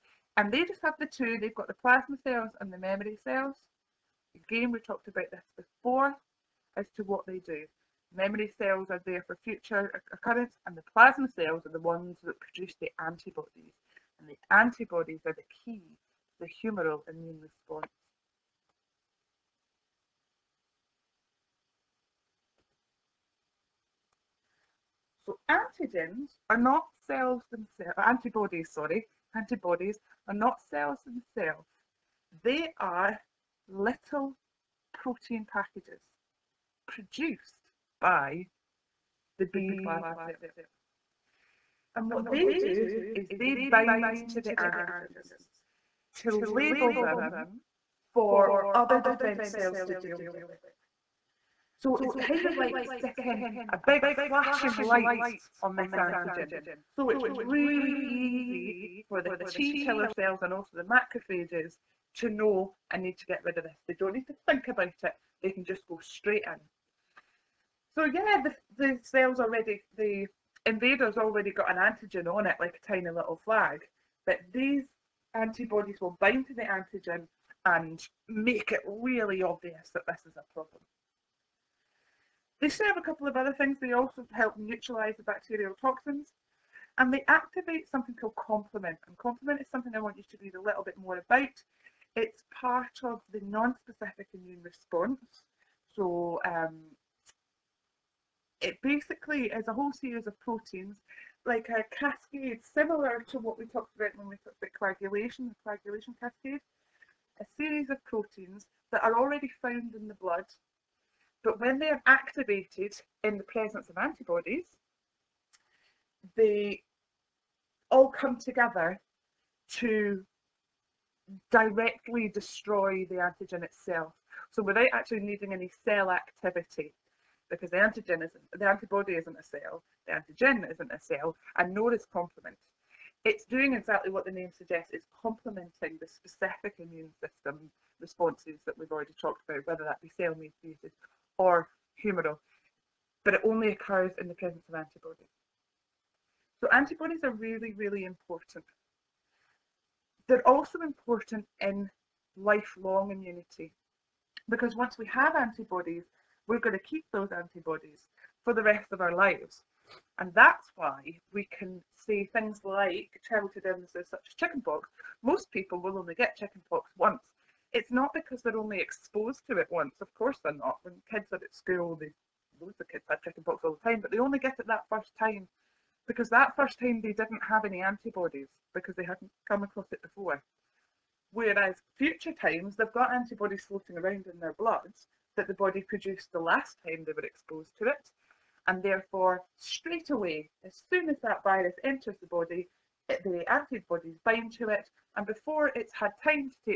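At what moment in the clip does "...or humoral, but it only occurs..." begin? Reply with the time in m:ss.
2:21.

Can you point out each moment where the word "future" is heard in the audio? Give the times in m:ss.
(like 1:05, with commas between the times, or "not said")
0:09, 3:01.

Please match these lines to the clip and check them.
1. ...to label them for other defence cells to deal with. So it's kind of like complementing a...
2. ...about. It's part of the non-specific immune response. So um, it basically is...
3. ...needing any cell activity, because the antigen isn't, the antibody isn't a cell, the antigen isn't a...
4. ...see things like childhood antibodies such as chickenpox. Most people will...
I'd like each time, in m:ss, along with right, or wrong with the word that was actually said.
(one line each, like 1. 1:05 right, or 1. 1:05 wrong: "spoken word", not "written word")
1. 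0:46 wrong: "sticking", not "complementing"
2. 1:31 right
3. 2:05 right
4. 2:41 wrong: "illnesses", not "antibodies".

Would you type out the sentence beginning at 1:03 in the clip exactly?
They don't need to think about it.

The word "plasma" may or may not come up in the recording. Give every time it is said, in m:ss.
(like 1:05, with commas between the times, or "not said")
0:01, 0:10, 0:39.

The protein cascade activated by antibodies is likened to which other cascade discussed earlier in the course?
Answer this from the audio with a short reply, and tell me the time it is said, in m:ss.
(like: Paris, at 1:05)
Coagulation cascade, at 1:45.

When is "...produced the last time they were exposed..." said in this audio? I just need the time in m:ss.
3:05.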